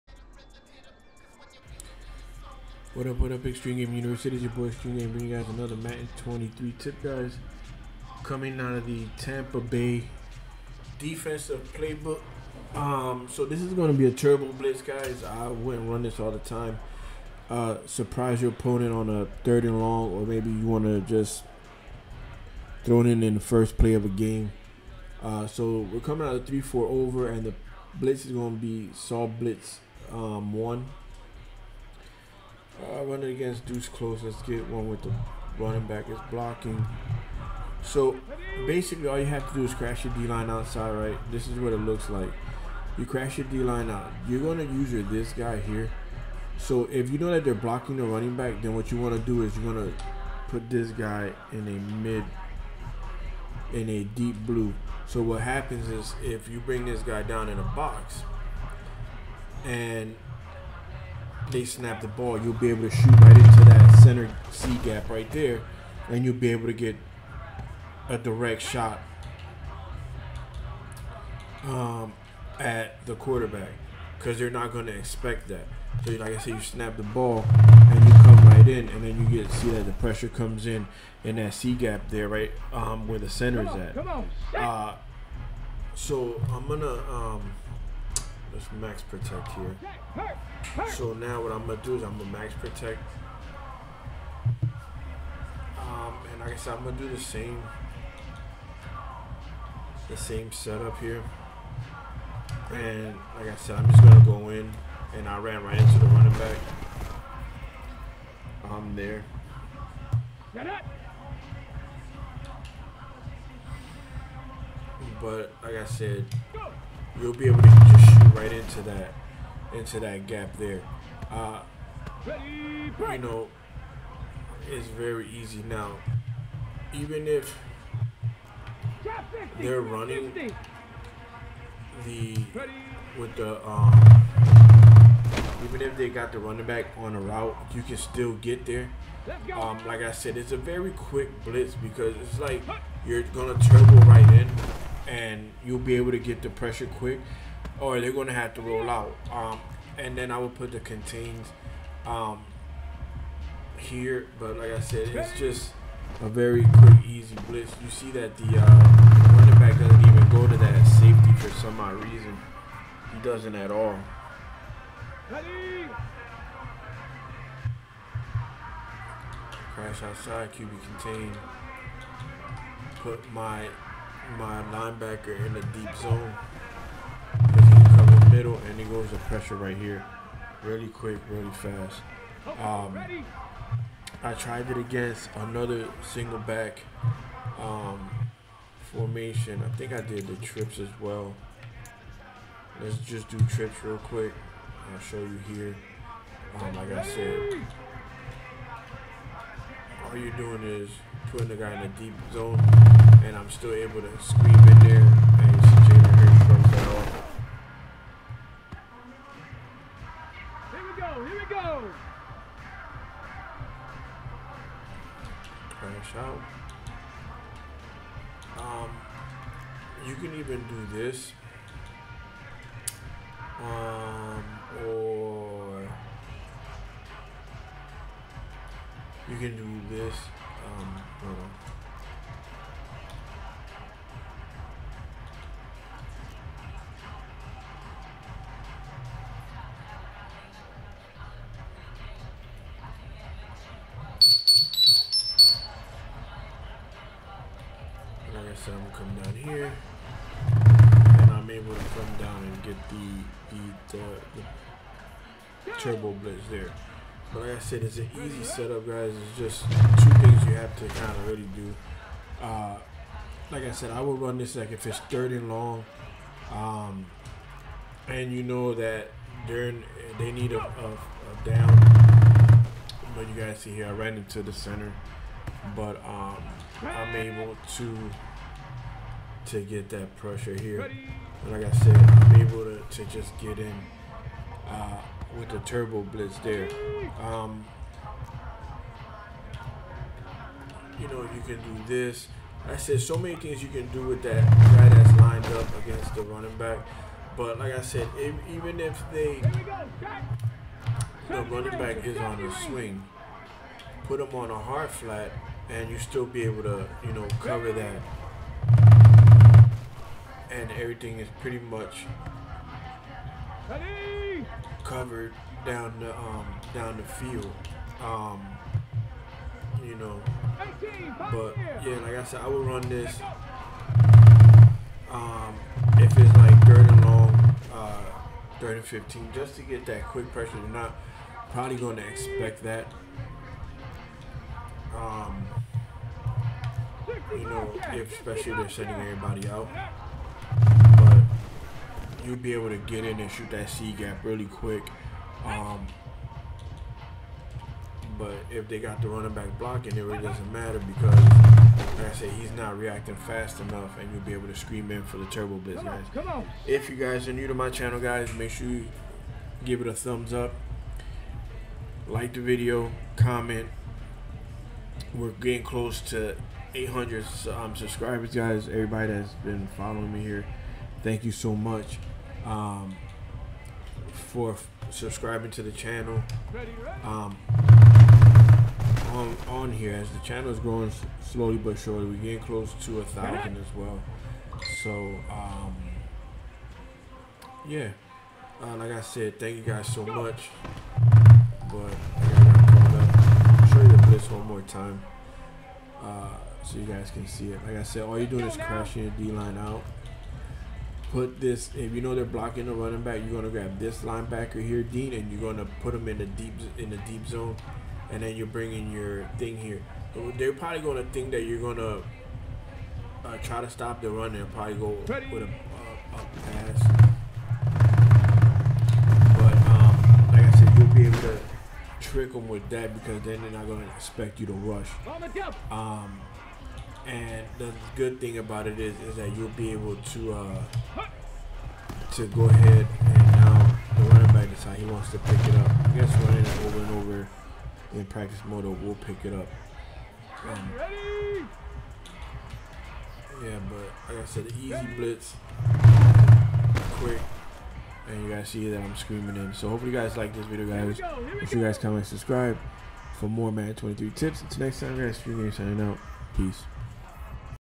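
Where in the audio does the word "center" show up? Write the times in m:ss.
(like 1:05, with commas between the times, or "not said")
1:04, 1:23, 4:34.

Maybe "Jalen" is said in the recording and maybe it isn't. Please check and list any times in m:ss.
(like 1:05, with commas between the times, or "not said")
3:25.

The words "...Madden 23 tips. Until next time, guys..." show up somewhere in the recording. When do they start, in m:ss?
7:33.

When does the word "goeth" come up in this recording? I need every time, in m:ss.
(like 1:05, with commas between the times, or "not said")
not said.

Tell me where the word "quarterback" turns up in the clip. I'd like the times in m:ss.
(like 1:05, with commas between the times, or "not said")
1:13.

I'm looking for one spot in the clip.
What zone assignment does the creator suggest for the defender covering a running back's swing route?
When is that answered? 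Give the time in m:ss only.
5:04.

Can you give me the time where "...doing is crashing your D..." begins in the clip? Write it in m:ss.
6:38.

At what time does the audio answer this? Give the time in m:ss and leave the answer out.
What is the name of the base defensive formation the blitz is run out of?
0:26.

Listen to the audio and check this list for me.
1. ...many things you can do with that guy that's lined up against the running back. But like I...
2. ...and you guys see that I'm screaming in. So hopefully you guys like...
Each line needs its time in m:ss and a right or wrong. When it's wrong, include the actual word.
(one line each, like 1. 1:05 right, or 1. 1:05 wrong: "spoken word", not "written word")
1. 4:53 right
2. 7:28 right.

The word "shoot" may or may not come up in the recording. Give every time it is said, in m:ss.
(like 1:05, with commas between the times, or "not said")
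1:02, 1:58, 5:43.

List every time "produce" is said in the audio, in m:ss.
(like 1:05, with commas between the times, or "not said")
not said.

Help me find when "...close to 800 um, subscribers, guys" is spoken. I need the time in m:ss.
6:05.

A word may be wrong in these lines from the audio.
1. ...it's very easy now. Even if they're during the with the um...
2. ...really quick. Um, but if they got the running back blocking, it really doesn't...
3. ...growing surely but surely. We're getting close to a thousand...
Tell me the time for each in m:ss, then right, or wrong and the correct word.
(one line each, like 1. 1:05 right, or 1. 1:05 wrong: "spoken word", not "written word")
1. 2:04 wrong: "running", not "during"
2. 5:44 right
3. 6:20 wrong: "slowly", not "surely".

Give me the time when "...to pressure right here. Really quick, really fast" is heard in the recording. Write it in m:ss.
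2:59.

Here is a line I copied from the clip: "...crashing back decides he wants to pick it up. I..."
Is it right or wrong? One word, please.
wrong.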